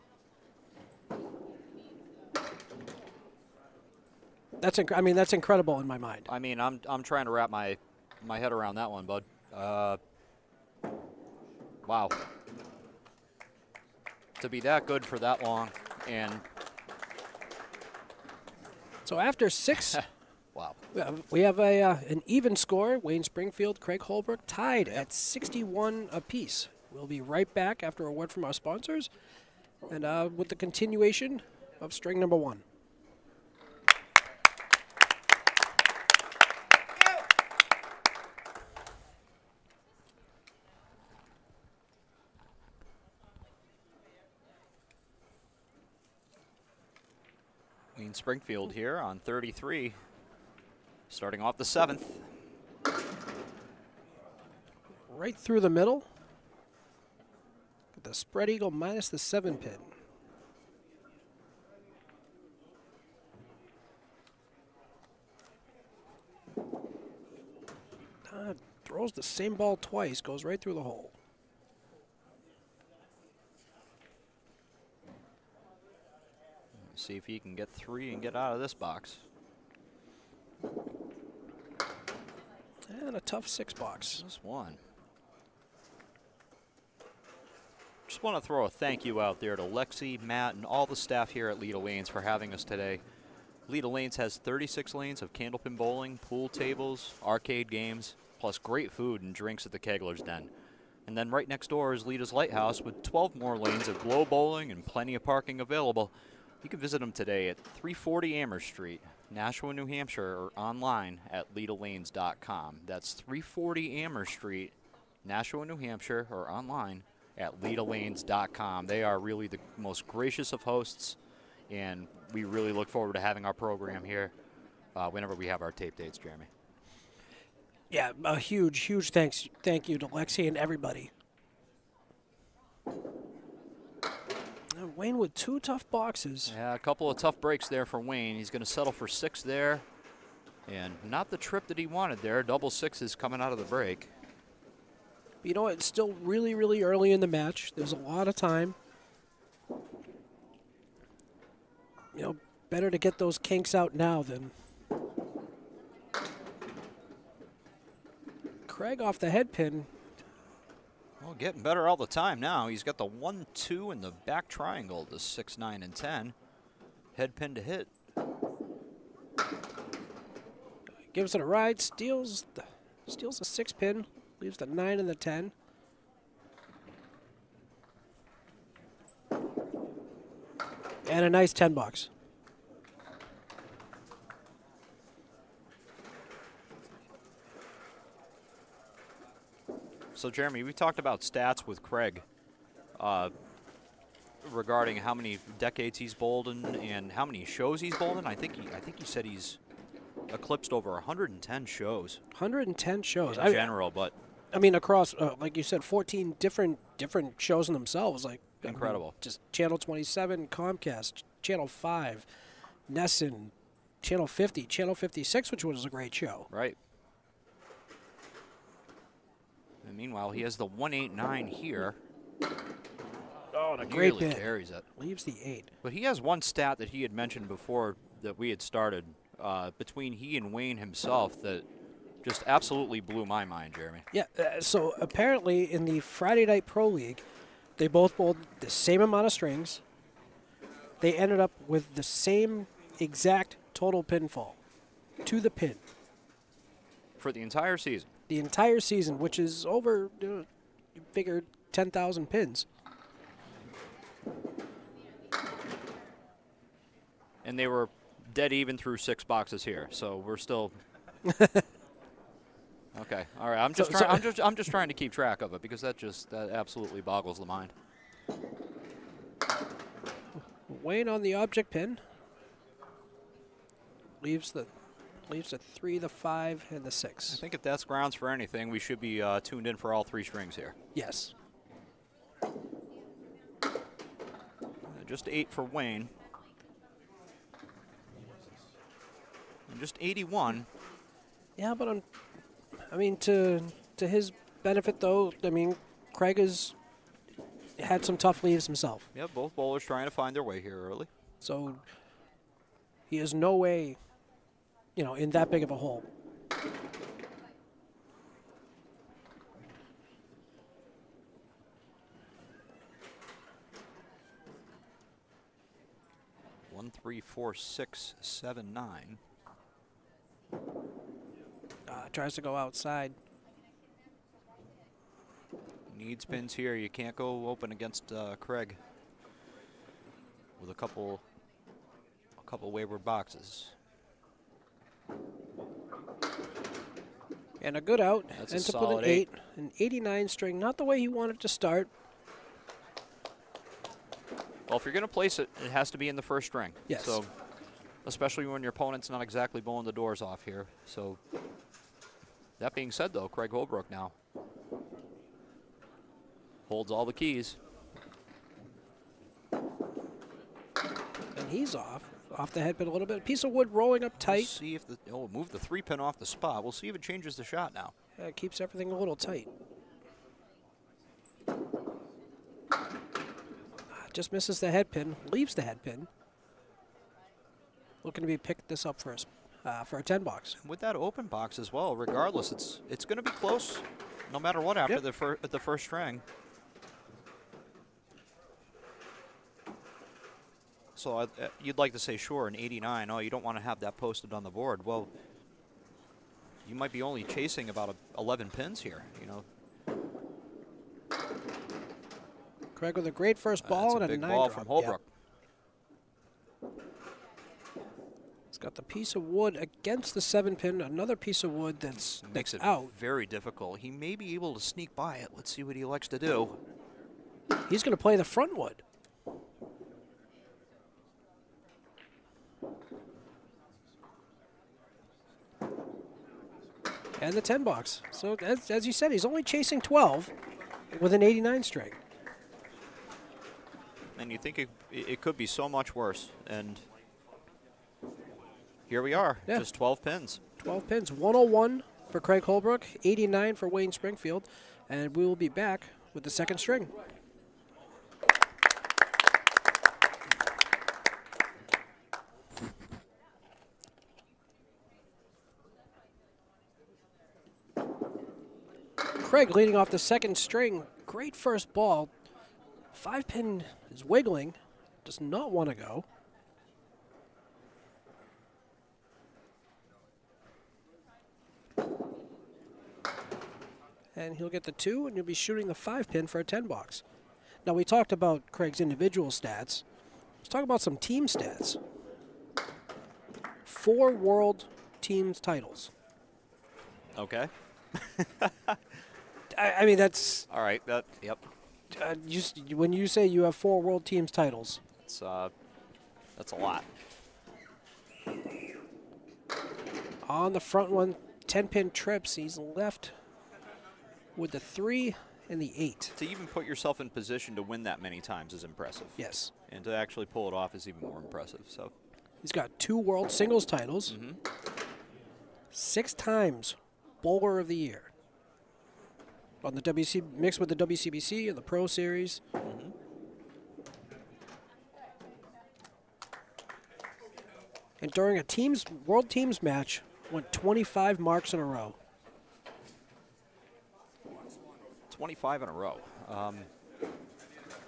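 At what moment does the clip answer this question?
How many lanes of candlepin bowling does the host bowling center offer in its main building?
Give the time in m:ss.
1:34.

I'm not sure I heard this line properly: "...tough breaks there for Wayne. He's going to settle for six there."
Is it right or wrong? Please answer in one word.
right.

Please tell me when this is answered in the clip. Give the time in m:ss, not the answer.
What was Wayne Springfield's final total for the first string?
5:39.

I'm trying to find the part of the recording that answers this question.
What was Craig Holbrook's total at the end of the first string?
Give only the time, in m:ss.
7:21.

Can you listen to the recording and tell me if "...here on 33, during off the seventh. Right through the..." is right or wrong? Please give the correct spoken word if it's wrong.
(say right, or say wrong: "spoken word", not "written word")
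wrong: "starting", not "during".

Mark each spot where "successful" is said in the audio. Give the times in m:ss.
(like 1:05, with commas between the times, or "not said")
not said.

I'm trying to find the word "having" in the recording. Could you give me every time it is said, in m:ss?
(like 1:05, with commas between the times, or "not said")
1:32, 2:03.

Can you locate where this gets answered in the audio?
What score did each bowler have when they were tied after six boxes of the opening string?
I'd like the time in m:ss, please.
0:25.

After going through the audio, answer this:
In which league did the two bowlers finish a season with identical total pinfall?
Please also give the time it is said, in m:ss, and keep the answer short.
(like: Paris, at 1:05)
Friday Night Pro League, at 3:55.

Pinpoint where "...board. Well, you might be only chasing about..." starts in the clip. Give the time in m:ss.
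6:34.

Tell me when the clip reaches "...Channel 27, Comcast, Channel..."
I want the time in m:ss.
3:29.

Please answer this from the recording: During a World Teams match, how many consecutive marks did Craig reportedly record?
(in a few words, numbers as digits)
25.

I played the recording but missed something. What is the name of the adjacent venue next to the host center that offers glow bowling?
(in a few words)
Leda's Lighthouse.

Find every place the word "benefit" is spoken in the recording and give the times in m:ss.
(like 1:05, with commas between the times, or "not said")
4:54.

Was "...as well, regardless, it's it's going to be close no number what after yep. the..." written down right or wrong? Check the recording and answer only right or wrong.
wrong.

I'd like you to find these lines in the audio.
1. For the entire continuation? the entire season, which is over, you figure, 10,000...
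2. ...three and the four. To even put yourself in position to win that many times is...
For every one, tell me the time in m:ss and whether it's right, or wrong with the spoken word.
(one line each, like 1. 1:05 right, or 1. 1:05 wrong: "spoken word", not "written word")
1. 4:07 wrong: "season", not "continuation"
2. 8:24 wrong: "eight", not "four".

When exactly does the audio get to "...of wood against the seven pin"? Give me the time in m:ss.
6:49.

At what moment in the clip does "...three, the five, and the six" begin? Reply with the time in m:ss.
4:35.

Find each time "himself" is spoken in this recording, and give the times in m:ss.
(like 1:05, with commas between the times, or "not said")
3:50, 4:58.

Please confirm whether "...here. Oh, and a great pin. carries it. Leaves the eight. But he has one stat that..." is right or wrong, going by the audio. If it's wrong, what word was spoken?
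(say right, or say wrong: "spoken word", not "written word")
right.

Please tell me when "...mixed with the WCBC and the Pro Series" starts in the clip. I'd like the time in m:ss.
8:40.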